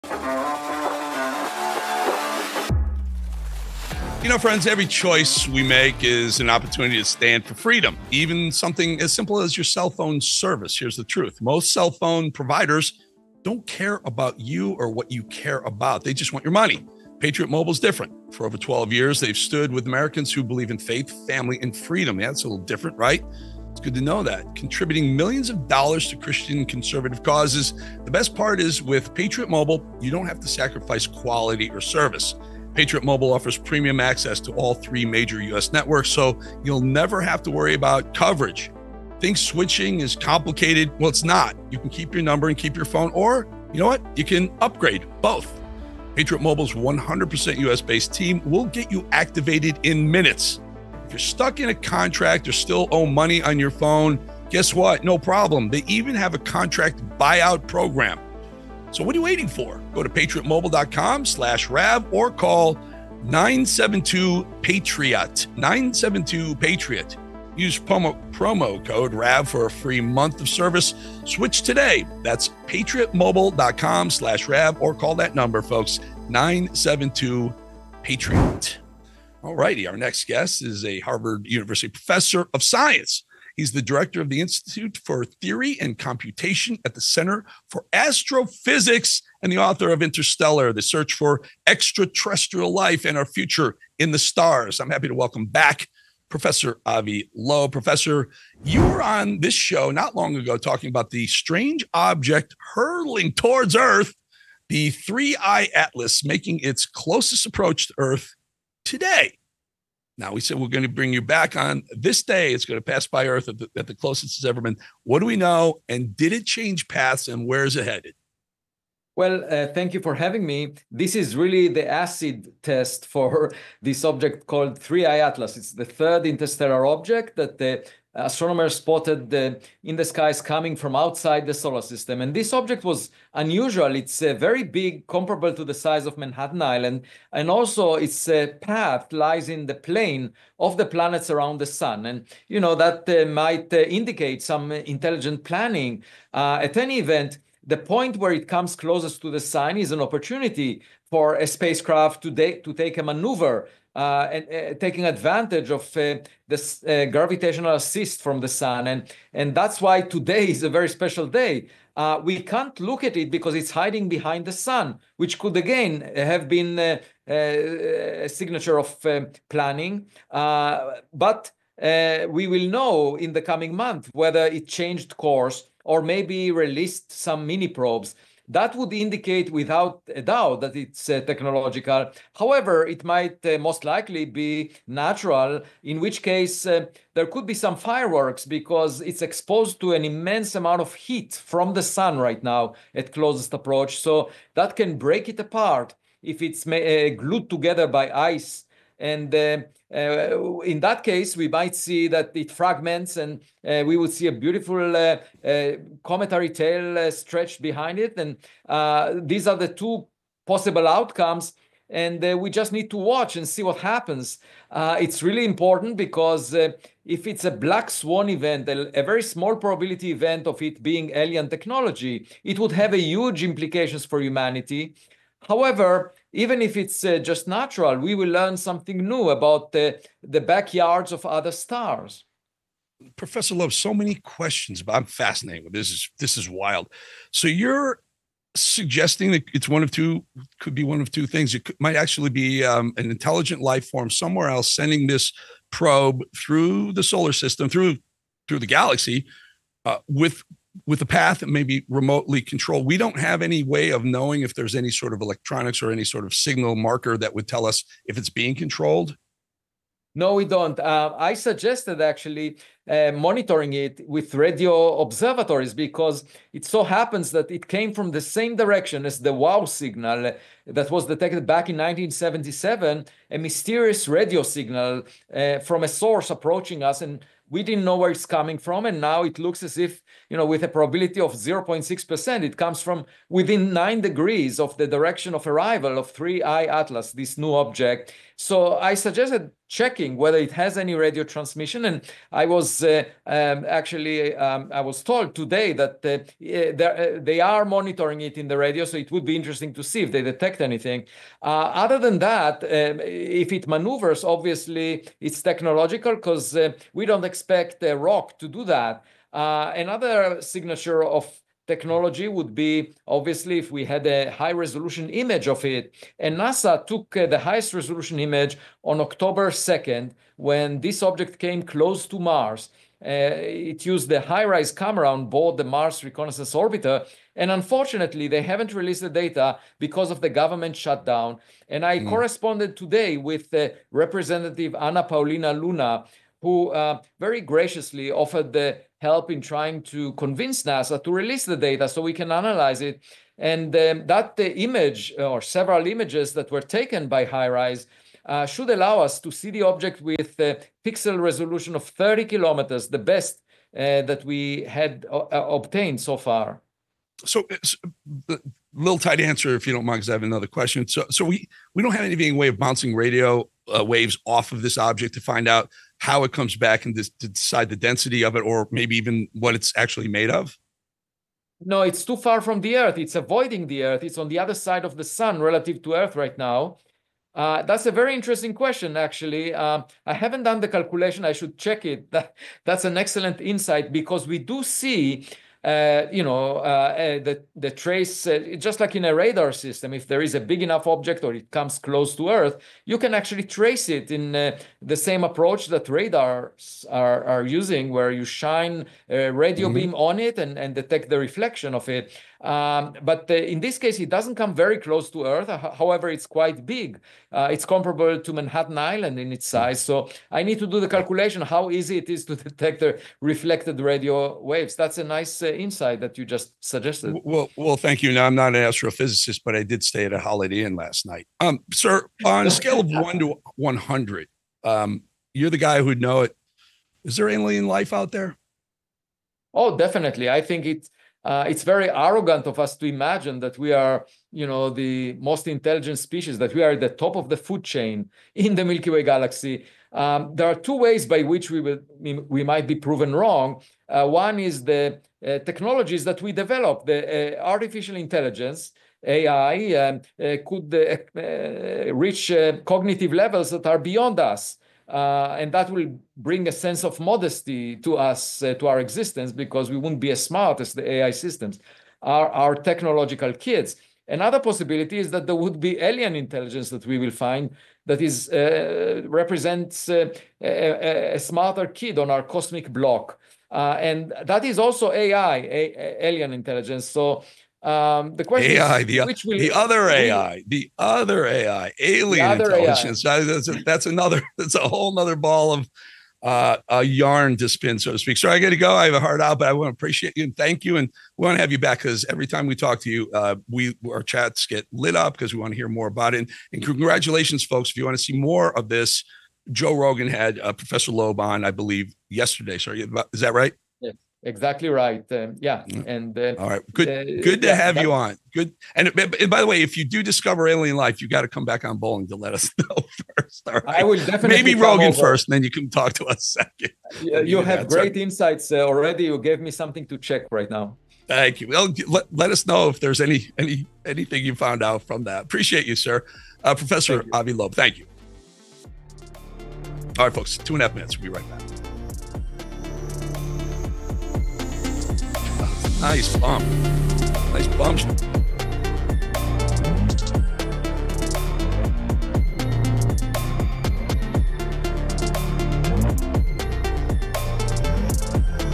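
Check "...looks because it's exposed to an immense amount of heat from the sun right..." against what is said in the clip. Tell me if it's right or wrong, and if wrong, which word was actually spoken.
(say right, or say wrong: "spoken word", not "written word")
wrong: "fireworks", not "looks".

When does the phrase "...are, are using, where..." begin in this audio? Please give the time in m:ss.
6:36.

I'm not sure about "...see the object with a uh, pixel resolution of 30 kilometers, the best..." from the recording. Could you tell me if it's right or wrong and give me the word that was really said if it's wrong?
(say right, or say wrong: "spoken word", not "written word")
right.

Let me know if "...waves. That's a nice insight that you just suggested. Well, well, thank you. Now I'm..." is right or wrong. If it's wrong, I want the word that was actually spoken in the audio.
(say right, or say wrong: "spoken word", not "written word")
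right.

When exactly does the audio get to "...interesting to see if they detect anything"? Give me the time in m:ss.
4:59.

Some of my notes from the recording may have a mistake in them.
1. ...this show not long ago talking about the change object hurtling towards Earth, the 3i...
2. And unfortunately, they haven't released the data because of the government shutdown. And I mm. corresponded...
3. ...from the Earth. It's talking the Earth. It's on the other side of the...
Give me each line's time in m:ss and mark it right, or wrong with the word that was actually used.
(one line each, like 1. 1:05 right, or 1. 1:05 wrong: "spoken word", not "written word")
1. 1:39 wrong: "strange", not "change"
2. 5:27 right
3. 6:12 wrong: "avoiding", not "talking".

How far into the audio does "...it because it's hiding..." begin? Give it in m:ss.
2:43.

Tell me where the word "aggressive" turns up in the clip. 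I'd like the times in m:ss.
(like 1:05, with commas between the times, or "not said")
not said.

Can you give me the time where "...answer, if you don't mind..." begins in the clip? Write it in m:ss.
5:59.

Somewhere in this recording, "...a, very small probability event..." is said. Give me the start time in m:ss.
3:38.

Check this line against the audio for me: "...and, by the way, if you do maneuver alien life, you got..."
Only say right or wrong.
wrong.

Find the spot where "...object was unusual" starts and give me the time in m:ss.
2:12.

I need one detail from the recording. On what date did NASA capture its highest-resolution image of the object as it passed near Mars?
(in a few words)
October 2nd.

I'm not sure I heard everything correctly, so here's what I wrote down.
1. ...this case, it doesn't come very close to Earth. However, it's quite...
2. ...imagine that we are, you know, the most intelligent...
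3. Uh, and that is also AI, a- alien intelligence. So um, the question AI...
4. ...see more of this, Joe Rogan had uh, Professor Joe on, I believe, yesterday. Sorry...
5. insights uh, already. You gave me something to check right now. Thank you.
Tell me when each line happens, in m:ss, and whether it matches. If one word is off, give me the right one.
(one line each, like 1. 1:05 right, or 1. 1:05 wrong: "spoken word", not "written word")
1. 6:43 right
2. 7:12 right
3. 7:53 right
4. 8:18 wrong: "Loeb", not "Joe"
5. 8:38 right.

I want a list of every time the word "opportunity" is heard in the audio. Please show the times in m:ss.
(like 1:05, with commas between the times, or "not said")
0:06, 2:30.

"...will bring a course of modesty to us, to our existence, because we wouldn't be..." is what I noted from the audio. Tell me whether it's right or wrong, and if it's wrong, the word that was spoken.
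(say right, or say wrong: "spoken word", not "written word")
wrong: "sense", not "course".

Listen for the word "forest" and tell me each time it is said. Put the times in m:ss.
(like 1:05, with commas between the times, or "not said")
not said.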